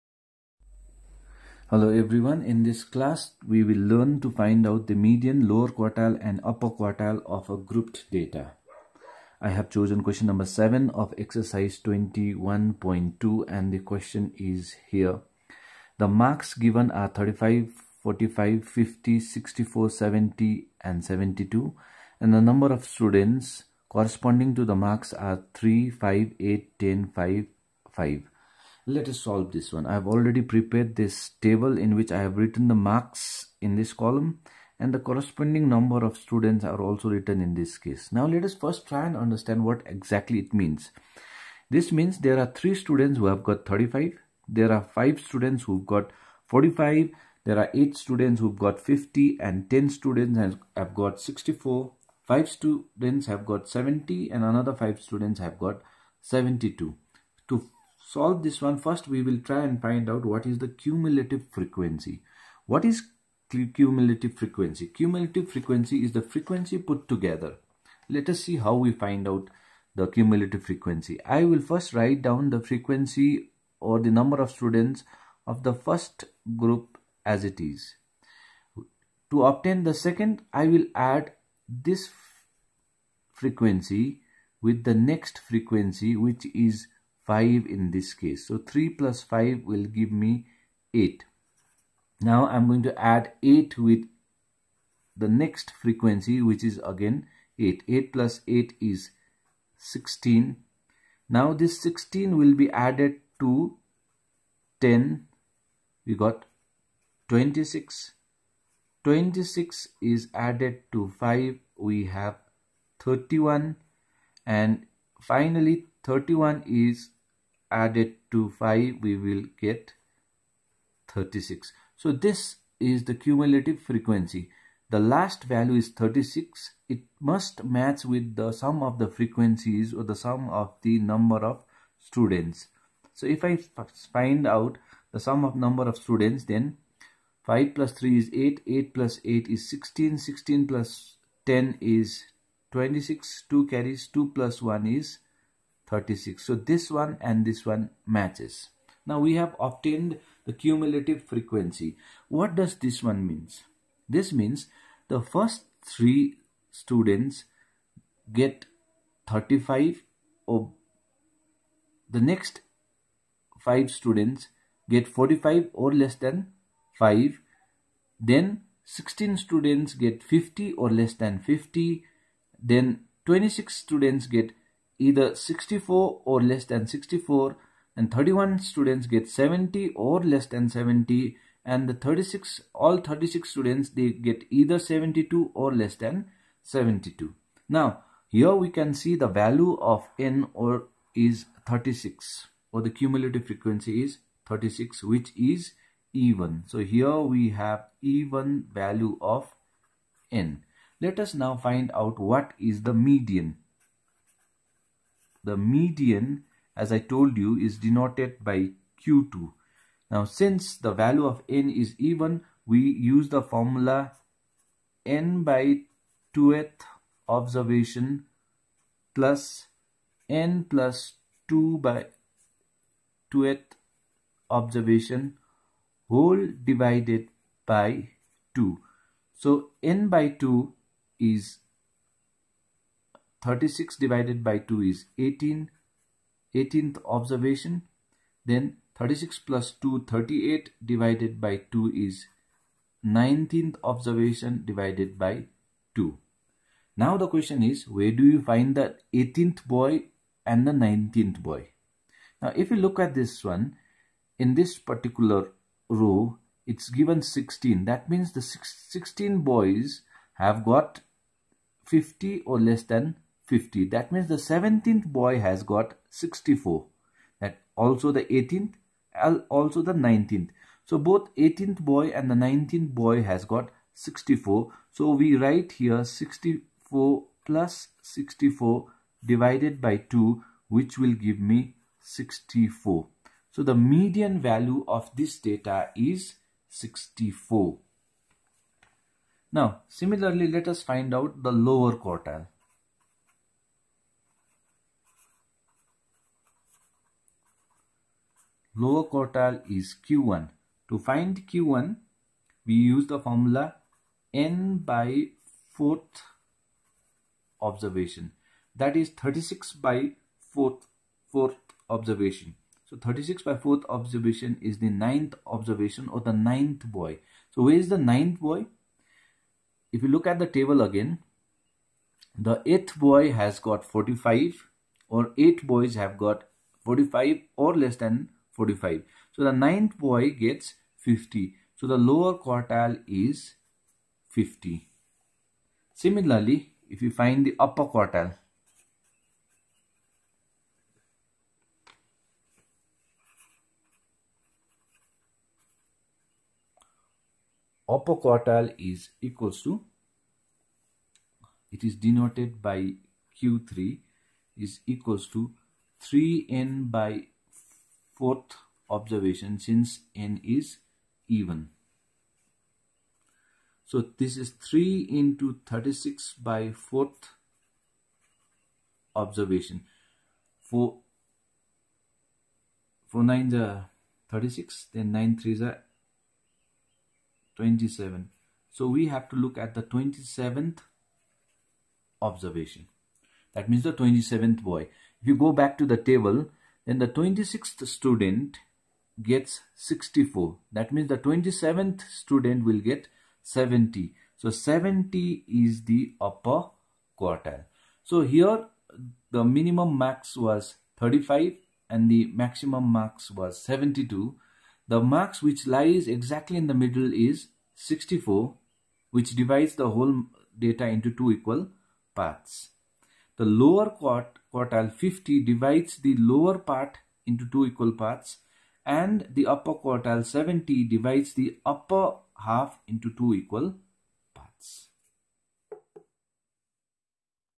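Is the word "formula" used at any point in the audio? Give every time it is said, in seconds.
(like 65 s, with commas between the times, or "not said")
213 s, 303 s.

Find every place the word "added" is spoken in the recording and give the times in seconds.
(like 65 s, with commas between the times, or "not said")
102 s, 110 s, 117 s.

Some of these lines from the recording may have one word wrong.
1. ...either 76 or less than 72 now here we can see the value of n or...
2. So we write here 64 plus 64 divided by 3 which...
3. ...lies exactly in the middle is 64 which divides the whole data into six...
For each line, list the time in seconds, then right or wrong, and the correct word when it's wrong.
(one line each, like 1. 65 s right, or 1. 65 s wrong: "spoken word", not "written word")
1. 184 s wrong: "72", not "76"
2. 274 s wrong: "2", not "3"
3. 405 s wrong: "two", not "six".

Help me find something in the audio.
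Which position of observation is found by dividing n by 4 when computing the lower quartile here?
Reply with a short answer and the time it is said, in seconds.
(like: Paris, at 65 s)
9th, at 314 s.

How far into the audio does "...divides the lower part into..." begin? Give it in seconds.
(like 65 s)
415 s.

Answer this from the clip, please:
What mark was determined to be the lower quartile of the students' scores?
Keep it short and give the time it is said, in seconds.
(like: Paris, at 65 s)
50, at 331 s.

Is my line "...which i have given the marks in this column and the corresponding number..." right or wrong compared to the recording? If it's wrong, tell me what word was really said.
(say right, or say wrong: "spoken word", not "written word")
wrong: "written", not "given".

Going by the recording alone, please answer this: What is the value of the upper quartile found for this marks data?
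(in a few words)
70.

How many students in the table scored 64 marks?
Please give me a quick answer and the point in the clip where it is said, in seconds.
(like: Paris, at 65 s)
10, at 49 s.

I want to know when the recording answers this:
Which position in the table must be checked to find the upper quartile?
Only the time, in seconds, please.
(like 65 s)
379 s.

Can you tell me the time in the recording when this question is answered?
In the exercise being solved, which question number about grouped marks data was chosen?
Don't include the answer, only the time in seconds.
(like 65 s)
10 s.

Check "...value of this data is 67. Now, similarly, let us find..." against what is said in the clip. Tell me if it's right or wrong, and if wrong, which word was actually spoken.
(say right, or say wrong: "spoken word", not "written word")
wrong: "64", not "67".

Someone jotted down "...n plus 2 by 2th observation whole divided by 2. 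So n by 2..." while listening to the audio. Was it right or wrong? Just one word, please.
right.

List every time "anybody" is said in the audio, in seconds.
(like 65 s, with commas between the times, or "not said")
not said.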